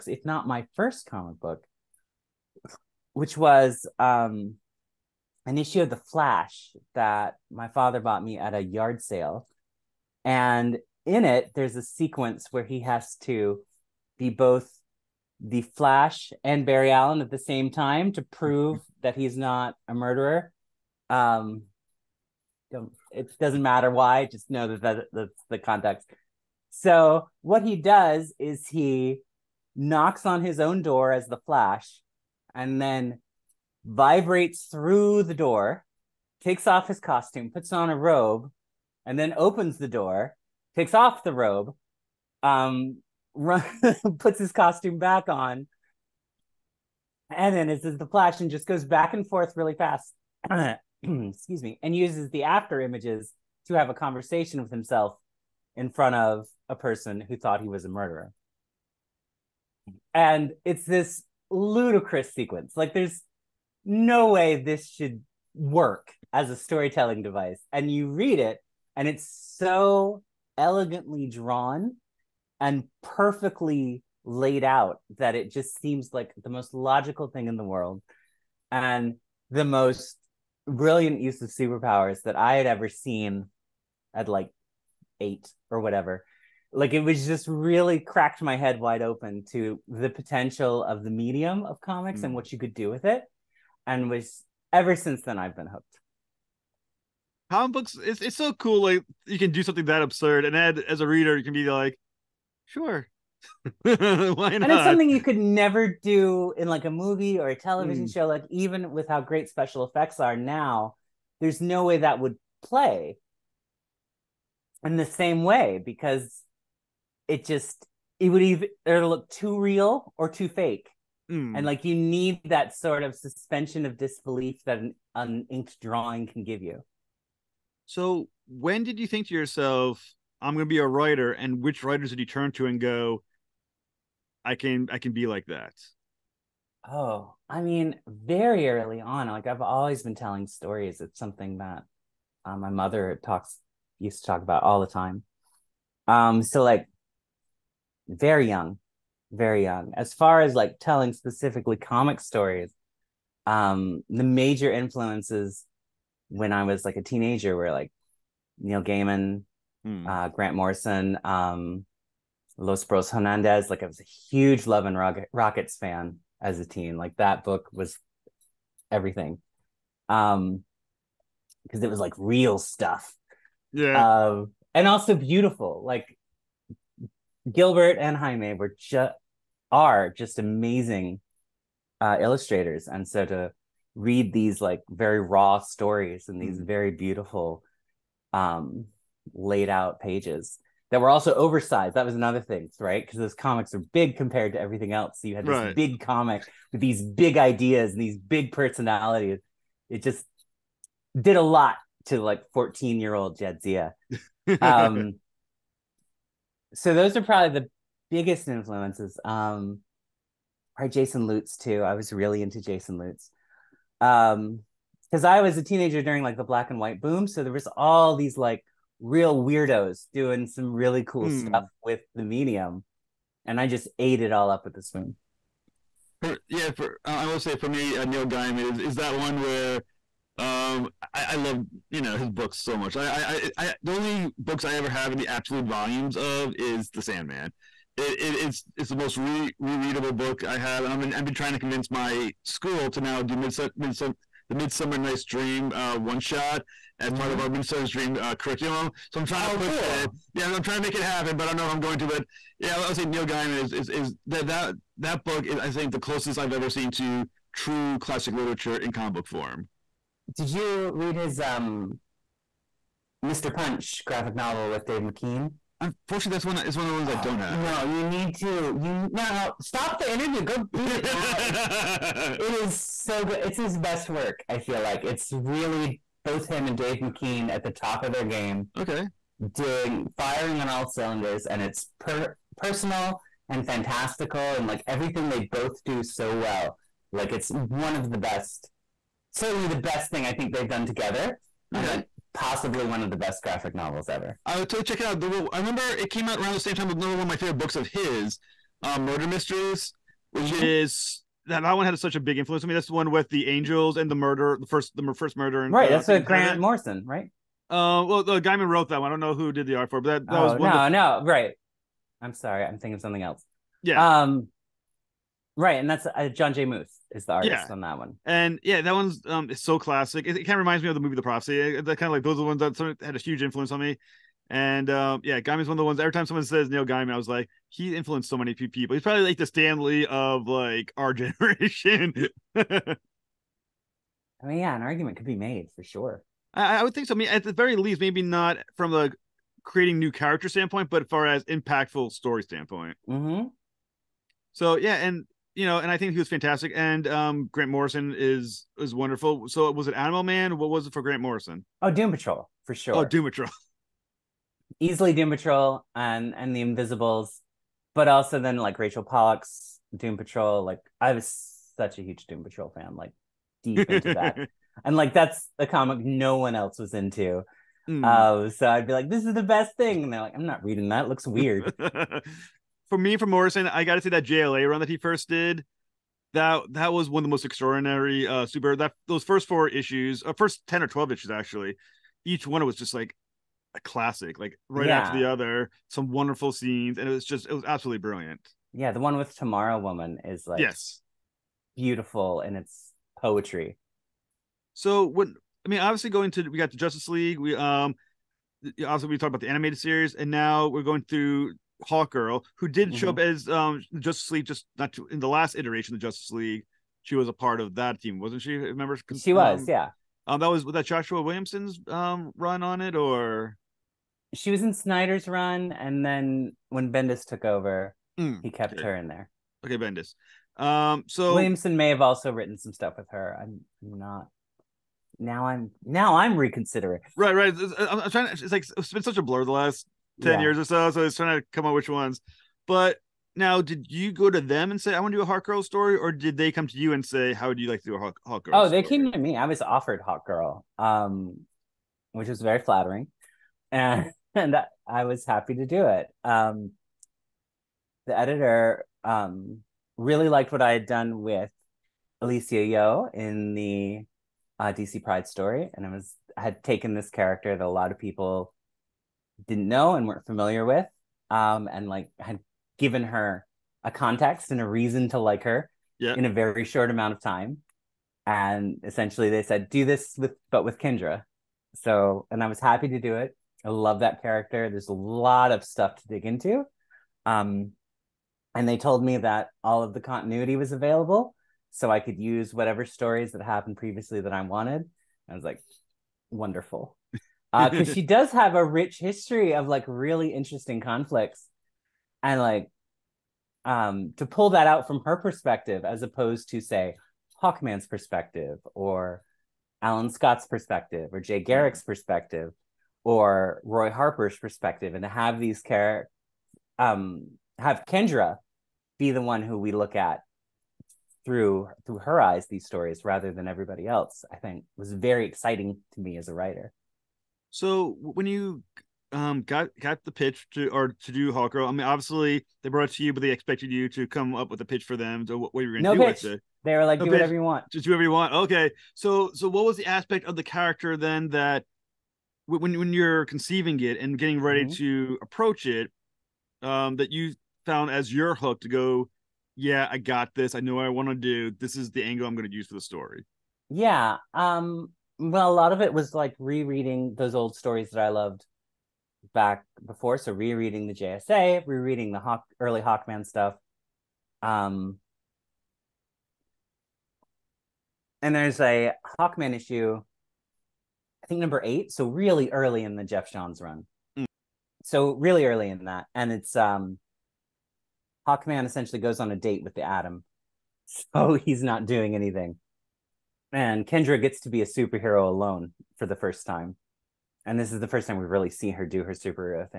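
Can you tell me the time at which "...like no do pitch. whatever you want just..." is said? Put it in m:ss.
8:46.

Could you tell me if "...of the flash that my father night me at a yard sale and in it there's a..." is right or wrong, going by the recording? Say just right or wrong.
wrong.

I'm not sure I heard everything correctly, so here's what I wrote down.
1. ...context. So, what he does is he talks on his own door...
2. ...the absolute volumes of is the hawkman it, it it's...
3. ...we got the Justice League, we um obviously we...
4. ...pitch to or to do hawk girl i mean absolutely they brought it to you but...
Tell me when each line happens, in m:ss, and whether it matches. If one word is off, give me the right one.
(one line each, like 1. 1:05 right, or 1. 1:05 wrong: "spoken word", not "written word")
1. 0:25 wrong: "knocks", not "talks"
2. 3:55 wrong: "sandman", not "hawkman"
3. 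6:36 right
4. 8:40 wrong: "obviously", not "absolutely".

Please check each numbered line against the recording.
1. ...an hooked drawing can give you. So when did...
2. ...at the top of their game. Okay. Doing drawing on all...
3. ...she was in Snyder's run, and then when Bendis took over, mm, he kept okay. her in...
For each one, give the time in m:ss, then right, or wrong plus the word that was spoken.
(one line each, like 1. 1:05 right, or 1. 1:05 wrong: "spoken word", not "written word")
1. 2:05 wrong: "inked", not "hooked"
2. 4:37 wrong: "firing", not "drawing"
3. 6:54 right.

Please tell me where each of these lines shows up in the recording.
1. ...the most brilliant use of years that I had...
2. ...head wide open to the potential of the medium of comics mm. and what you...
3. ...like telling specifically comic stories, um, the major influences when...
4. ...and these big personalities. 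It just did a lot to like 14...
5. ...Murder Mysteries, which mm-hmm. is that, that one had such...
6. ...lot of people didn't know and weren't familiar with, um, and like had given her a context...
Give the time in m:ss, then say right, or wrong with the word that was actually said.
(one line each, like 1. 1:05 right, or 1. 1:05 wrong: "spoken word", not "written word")
1. 1:19 wrong: "superpowers", not "years"
2. 1:28 right
3. 2:30 right
4. 3:17 right
5. 4:58 right
6. 7:37 right.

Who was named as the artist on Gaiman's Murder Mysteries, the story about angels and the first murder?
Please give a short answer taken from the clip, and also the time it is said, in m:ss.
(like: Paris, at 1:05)
John J. Muth, at 5:16.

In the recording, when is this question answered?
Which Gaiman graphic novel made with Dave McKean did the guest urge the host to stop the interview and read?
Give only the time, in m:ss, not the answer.
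4:23.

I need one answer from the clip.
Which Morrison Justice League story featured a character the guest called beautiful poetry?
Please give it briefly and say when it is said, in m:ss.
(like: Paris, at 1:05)
Tomorrow Woman, at 6:29.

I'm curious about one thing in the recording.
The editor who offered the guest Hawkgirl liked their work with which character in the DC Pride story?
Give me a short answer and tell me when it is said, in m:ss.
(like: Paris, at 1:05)
Alysia Yeoh, at 7:32.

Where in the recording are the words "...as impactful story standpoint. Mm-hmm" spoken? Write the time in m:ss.
5:41.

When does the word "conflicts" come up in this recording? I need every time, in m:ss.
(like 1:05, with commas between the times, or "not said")
8:10.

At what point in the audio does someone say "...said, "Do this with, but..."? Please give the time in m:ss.
7:49.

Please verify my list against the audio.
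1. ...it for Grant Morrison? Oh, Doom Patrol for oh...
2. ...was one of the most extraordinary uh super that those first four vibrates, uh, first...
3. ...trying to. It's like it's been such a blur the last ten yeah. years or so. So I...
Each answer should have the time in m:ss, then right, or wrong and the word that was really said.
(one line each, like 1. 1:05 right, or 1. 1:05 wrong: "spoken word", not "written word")
1. 5:50 right
2. 6:16 wrong: "issues", not "vibrates"
3. 7:08 right.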